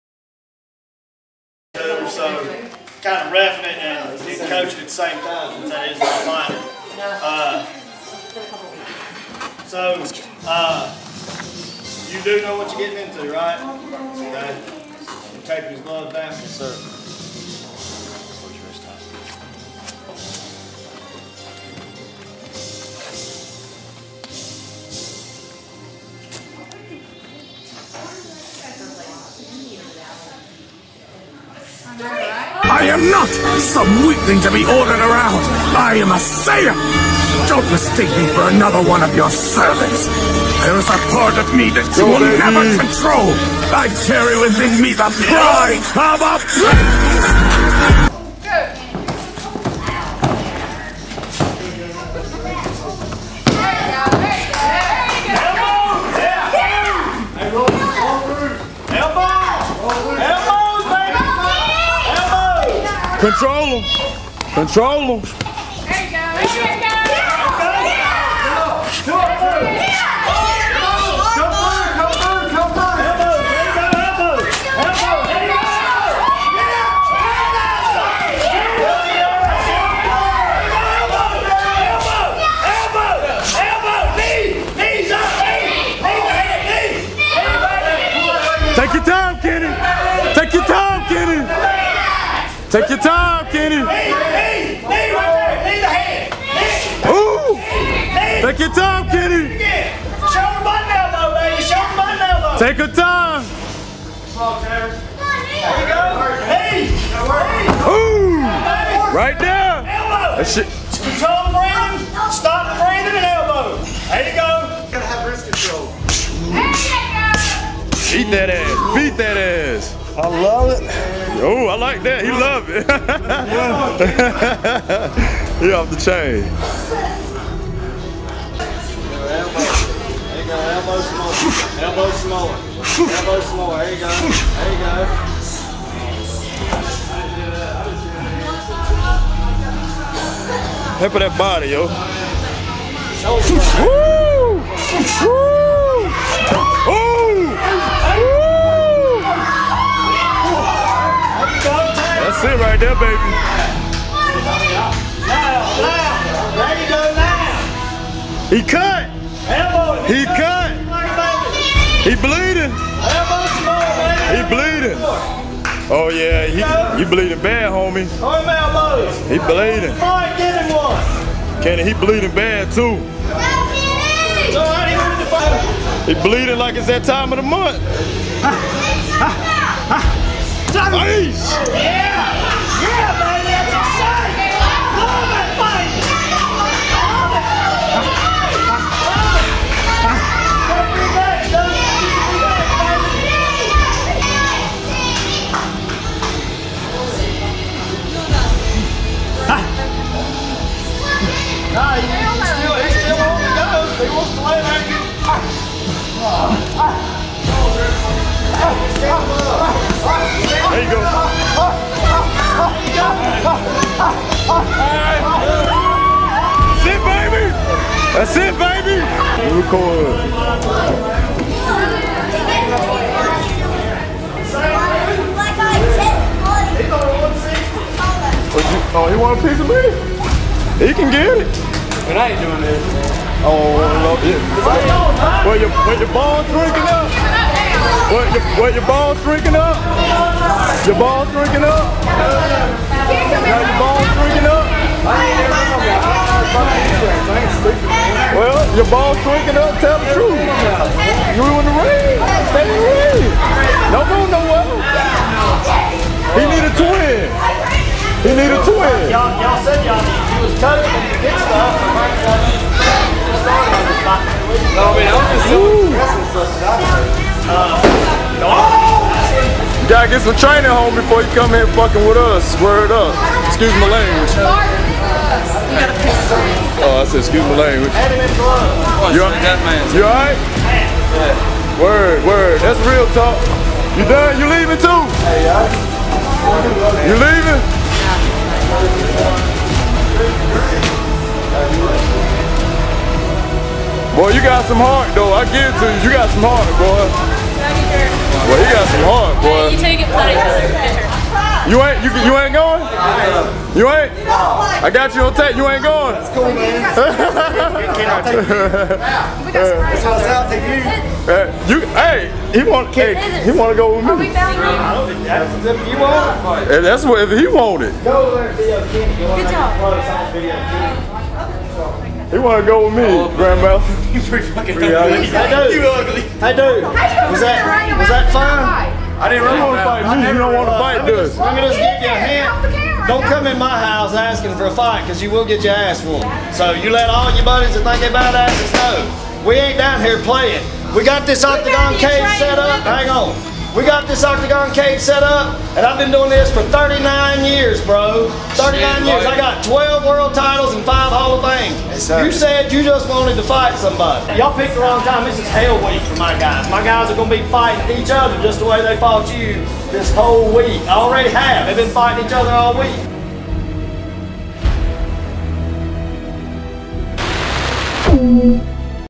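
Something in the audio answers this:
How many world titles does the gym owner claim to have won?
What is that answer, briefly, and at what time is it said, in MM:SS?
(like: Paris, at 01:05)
12, at 05:49.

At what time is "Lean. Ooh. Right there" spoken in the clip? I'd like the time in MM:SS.
01:47.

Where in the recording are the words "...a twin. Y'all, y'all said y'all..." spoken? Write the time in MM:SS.
04:18.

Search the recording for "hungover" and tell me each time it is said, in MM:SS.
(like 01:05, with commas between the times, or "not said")
not said.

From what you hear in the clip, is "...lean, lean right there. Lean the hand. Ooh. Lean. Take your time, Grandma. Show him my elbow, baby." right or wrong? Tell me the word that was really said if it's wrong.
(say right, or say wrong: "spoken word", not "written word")
wrong: "Kenny", not "Grandma".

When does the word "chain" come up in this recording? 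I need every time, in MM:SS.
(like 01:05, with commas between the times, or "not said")
02:05.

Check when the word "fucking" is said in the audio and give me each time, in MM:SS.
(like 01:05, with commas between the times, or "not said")
04:31, 05:24.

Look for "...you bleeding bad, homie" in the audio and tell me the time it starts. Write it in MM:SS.
02:47.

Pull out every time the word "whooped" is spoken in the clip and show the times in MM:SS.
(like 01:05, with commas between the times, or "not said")
05:36.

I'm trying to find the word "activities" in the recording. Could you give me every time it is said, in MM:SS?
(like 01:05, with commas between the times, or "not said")
not said.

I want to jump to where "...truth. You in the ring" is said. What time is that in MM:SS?
04:10.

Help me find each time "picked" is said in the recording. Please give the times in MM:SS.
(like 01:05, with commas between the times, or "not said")
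05:54.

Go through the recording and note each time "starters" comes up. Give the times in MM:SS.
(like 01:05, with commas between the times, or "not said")
not said.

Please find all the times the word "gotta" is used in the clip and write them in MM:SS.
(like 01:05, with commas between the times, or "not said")
01:54, 04:29.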